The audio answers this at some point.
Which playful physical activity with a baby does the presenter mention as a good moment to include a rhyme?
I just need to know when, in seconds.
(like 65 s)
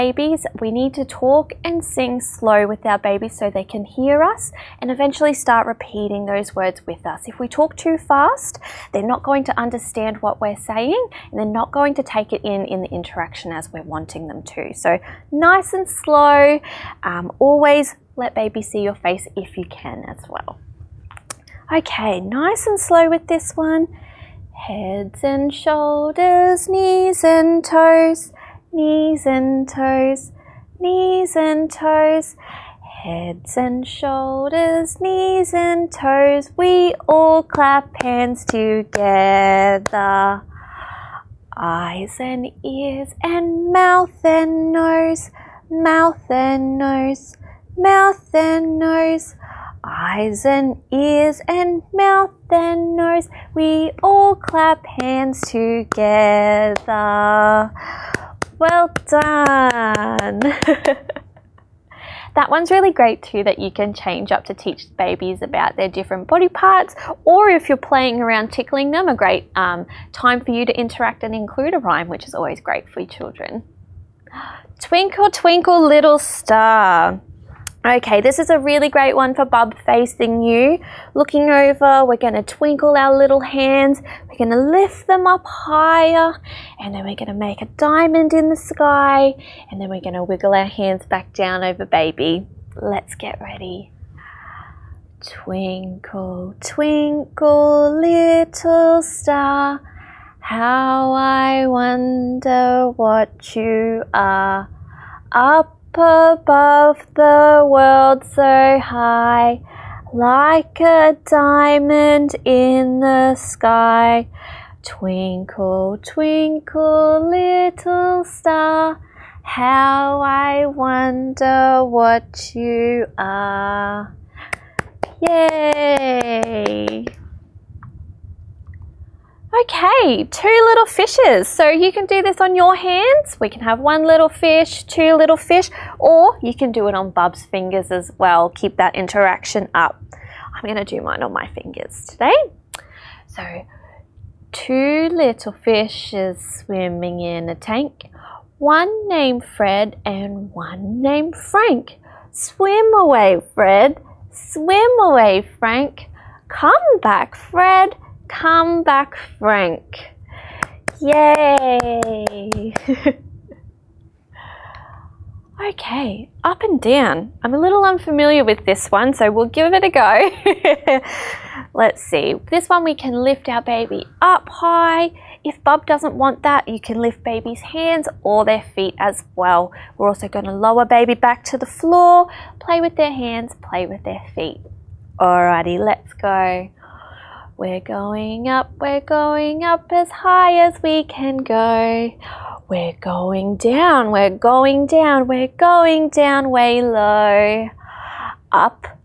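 68 s.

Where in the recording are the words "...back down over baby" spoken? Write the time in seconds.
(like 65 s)
91 s.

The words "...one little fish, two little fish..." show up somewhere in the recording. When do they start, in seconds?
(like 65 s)
133 s.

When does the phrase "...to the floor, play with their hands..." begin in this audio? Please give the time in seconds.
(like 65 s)
181 s.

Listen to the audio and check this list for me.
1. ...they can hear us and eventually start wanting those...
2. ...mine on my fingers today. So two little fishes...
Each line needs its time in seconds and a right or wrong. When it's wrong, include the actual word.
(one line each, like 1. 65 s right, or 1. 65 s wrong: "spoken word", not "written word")
1. 3 s wrong: "repeating", not "wanting"
2. 141 s right.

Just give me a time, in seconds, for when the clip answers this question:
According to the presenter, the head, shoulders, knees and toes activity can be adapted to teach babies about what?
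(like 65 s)
65 s.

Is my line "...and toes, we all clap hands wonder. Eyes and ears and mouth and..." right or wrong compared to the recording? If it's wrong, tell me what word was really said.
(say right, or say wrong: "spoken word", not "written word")
wrong: "together", not "wonder".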